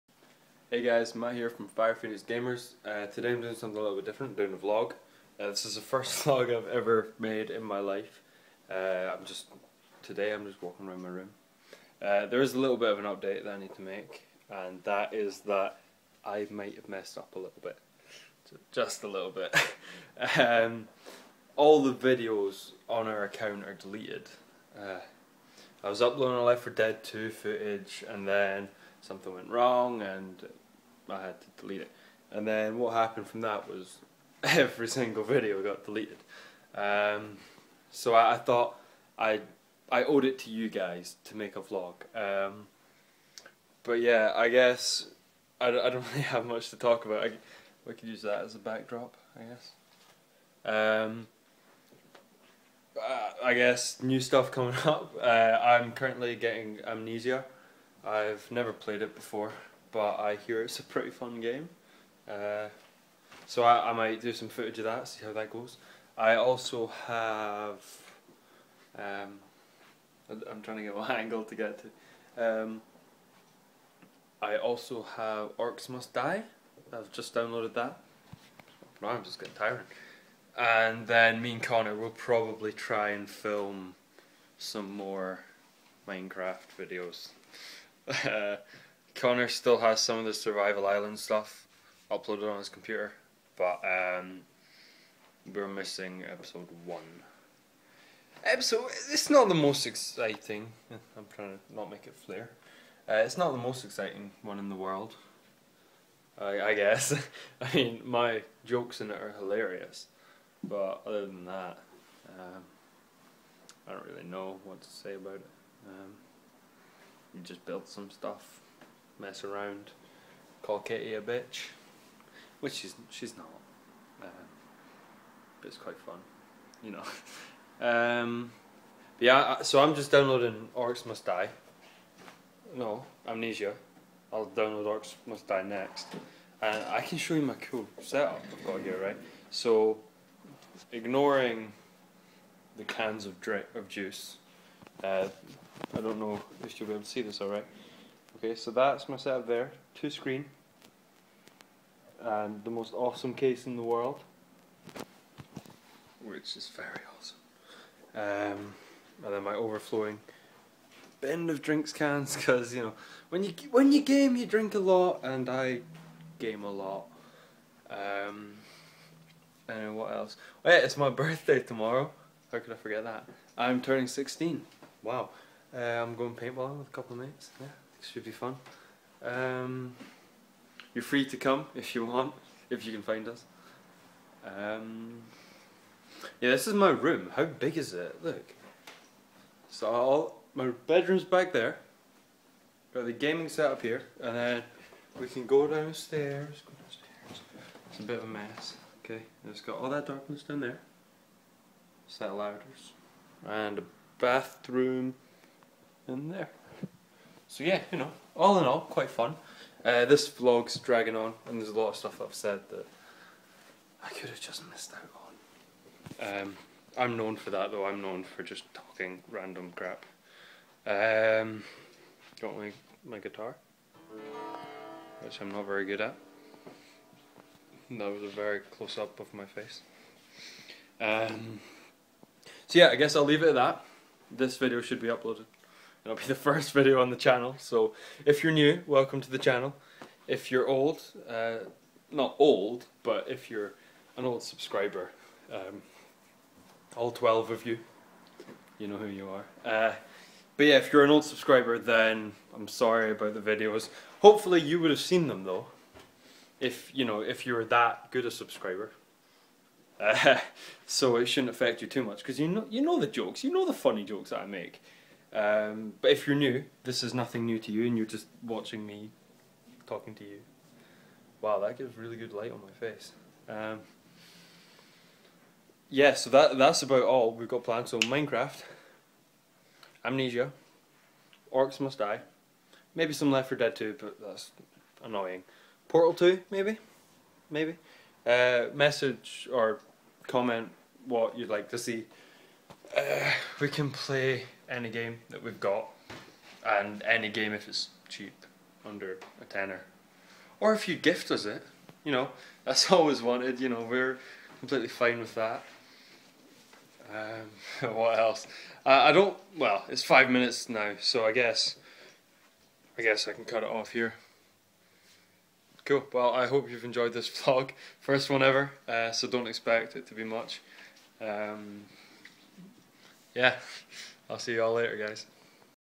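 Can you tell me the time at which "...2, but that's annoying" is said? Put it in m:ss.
4:43.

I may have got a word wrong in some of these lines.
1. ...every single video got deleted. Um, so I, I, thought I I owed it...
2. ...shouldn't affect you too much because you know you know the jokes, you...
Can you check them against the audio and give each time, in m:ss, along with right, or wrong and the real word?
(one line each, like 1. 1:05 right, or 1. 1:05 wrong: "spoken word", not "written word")
1. 0:34 right
2. 4:21 right.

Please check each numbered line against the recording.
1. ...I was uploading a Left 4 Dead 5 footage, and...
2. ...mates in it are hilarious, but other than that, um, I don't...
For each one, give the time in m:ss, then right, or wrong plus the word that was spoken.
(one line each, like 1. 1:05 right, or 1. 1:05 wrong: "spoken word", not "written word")
1. 0:25 wrong: "2", not "5"
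2. 1:48 wrong: "jokes", not "mates".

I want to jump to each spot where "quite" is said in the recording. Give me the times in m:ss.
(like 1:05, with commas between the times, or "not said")
2:05, 3:28.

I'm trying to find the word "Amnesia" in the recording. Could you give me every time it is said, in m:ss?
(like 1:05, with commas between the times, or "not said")
0:56, 2:13, 4:40.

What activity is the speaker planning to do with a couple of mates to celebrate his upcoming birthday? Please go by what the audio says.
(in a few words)
paintballing.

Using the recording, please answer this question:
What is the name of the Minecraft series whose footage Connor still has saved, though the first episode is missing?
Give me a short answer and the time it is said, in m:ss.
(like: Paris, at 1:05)
Survival Island, at 1:30.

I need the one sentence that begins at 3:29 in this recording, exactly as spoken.
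Uh, this vlog's dragging on, and there's a lot of stuff I've said that I could have just missed out on.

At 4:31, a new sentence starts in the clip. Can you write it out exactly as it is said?
Wow, that gives really good light on my face.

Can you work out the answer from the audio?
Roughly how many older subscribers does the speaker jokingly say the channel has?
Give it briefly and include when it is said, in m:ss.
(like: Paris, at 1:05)
12, at 4:07.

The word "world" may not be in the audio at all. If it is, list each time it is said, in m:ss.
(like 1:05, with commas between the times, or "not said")
1:44, 2:33.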